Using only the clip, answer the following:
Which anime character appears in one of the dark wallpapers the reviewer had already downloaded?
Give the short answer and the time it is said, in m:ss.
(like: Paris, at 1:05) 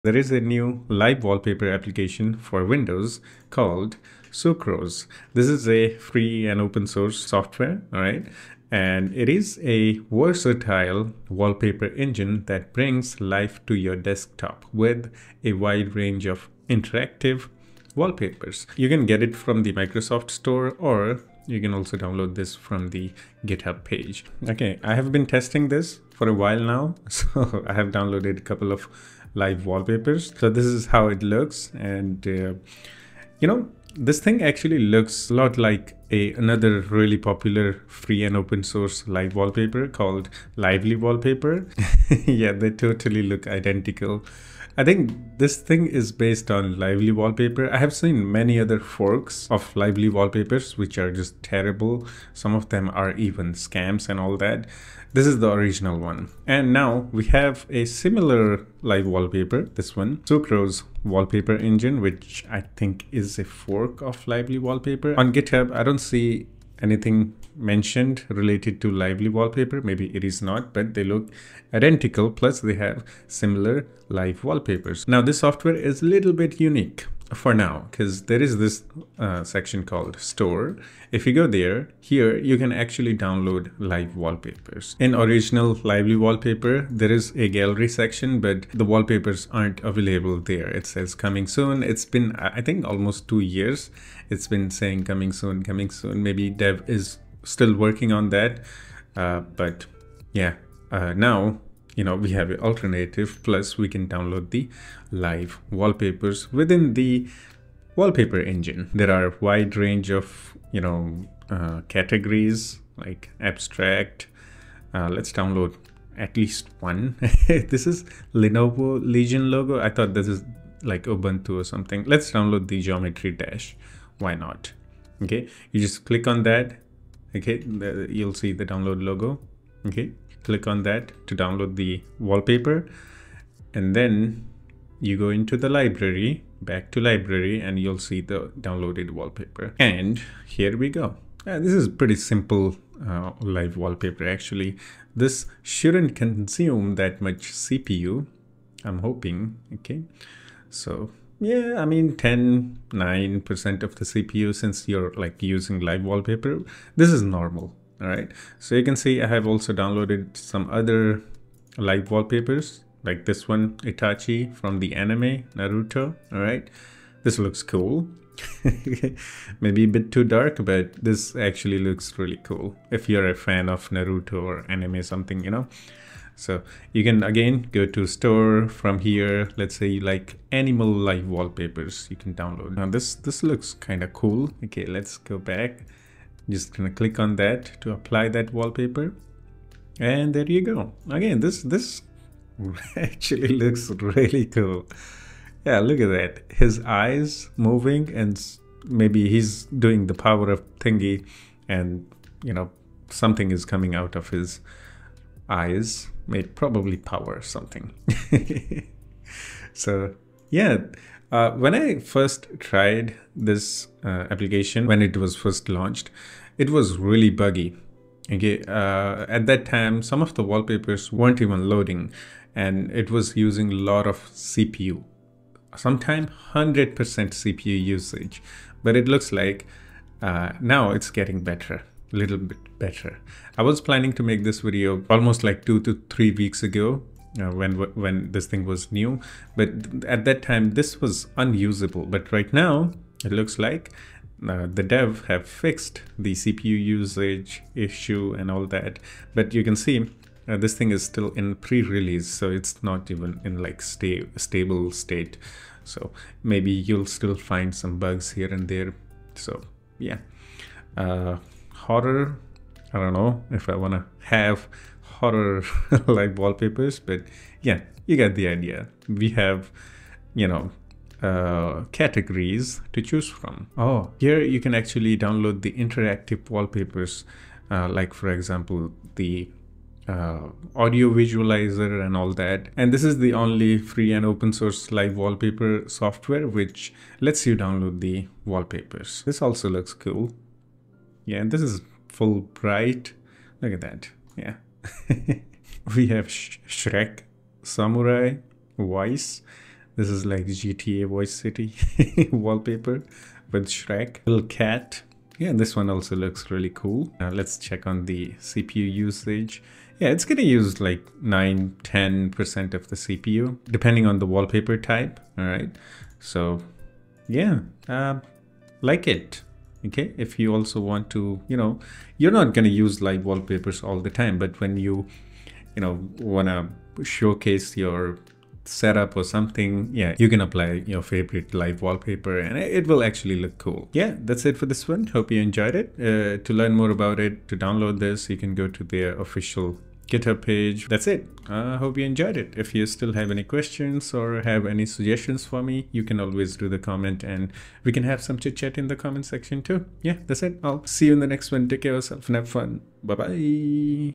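Itachi, at 2:43.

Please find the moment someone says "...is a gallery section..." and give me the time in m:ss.
1:27.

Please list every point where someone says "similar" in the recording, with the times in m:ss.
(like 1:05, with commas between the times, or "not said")
0:57, 1:13.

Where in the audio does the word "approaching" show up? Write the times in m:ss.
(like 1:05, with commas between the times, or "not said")
not said.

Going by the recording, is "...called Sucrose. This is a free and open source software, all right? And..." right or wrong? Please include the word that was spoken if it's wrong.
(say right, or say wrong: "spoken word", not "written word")
right.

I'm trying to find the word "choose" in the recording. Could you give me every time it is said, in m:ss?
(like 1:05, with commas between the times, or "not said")
4:33.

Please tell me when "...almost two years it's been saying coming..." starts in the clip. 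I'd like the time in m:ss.
1:32.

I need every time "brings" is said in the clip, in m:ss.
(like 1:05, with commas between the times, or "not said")
0:12.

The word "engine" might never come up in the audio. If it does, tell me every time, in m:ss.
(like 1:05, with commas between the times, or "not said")
0:11, 1:01, 1:48.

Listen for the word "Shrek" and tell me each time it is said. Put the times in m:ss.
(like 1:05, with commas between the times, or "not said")
4:56, 5:03.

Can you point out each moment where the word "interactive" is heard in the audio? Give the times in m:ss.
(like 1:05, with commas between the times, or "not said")
0:16, 4:35.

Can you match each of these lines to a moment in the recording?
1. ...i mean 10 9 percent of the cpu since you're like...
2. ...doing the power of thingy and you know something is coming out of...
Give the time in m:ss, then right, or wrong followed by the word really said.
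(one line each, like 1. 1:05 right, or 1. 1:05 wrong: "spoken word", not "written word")
1. 2:31 right
2. 3:19 right.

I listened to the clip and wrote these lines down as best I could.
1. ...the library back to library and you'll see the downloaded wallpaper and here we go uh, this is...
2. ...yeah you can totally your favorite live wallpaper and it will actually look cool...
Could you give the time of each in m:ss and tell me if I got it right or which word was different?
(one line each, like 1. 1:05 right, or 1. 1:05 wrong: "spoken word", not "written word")
1. 2:15 right
2. 5:29 wrong: "apply", not "totally".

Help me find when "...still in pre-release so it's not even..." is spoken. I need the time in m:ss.
4:11.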